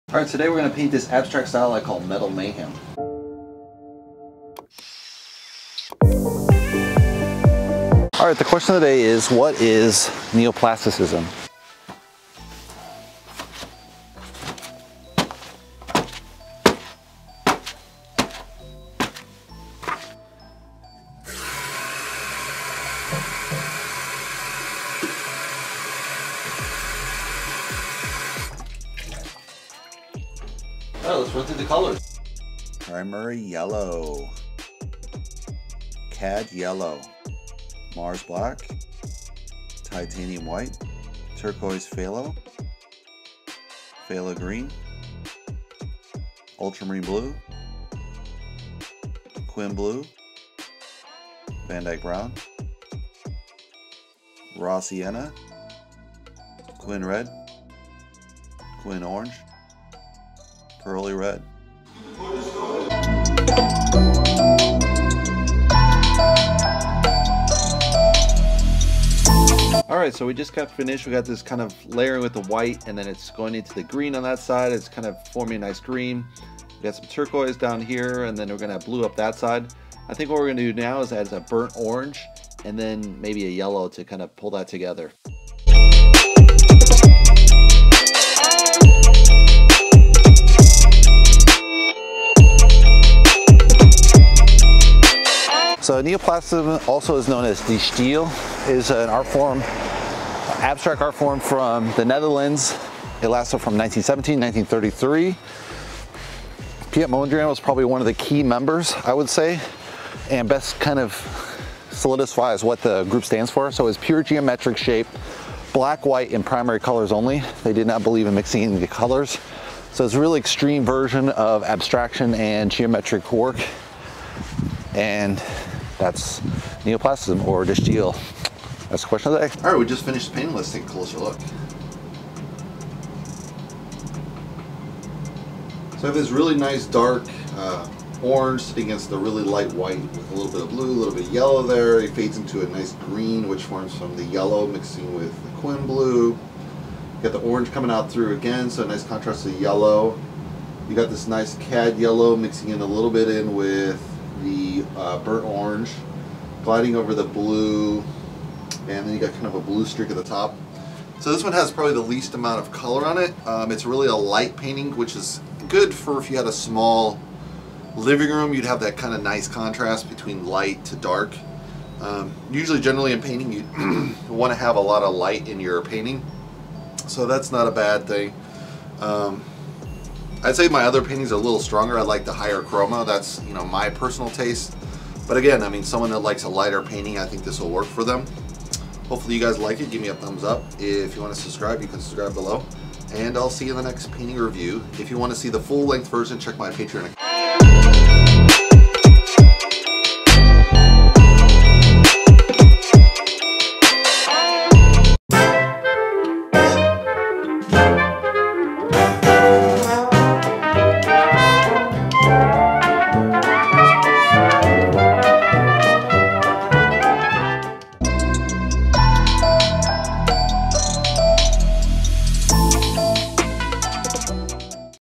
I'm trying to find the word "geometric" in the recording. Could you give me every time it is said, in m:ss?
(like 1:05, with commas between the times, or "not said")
1:54, 2:02.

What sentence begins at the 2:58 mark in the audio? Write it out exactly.
Um, I'd say my other painting's a little stronger.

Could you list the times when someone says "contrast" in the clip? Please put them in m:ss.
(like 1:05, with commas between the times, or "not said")
2:29, 2:49.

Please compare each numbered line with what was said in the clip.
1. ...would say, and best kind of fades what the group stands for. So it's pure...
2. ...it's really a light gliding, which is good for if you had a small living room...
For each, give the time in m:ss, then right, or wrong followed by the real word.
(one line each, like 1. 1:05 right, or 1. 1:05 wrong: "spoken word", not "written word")
1. 1:49 wrong: "solidifies", not "fades"
2. 2:43 wrong: "painting", not "gliding".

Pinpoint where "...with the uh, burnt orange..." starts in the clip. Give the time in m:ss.
2:33.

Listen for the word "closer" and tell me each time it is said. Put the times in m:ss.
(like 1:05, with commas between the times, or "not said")
2:10.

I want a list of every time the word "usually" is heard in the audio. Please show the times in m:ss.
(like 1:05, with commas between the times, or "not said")
2:52.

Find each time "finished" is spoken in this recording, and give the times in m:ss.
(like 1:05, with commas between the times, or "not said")
1:10, 2:10.